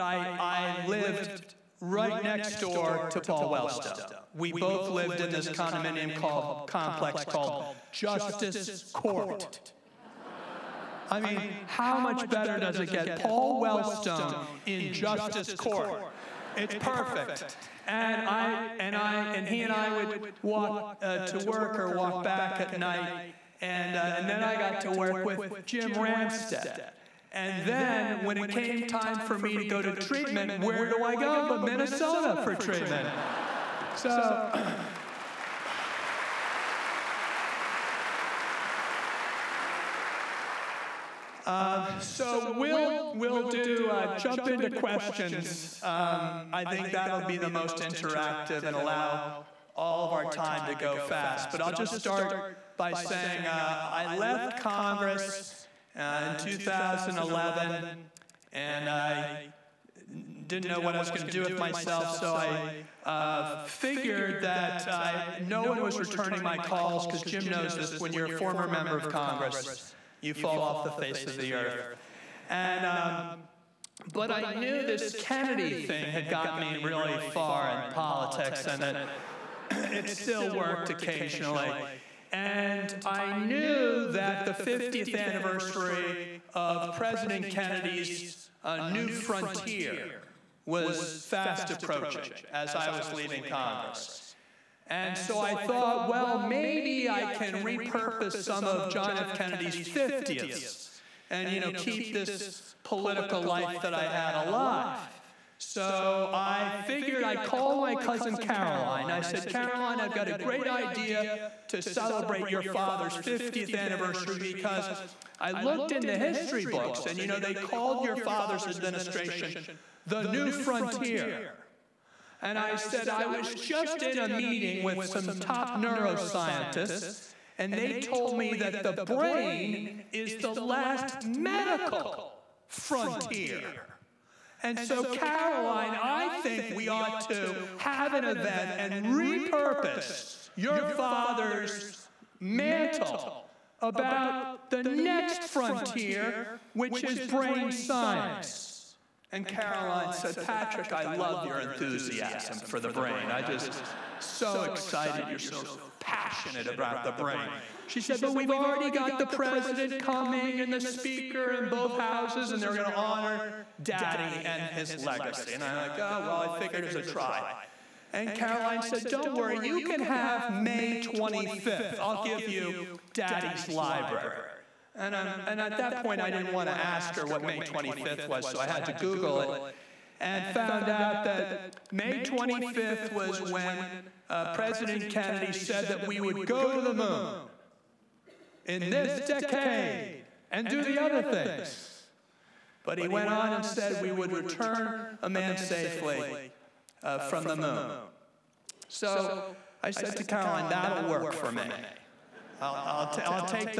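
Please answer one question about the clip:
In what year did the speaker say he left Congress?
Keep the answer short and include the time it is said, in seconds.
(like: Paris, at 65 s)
2011, at 56 s.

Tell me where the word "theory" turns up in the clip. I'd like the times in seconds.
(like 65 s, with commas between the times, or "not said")
not said.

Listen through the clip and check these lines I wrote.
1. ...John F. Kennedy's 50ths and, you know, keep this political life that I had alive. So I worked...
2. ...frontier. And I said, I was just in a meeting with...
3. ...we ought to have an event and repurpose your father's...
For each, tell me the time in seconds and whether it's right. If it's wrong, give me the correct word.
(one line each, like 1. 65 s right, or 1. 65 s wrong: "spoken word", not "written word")
1. 98 s wrong: "figured", not "worked"
2. 120 s right
3. 136 s right.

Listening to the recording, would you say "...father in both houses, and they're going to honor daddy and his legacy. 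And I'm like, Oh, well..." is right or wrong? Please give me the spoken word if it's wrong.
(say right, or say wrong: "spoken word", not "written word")
wrong: "speaker", not "father".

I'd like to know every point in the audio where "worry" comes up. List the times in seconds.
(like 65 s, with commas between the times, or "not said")
169 s.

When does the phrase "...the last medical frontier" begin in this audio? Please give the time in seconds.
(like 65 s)
130 s.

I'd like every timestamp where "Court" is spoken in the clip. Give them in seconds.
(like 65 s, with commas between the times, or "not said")
8 s, 15 s.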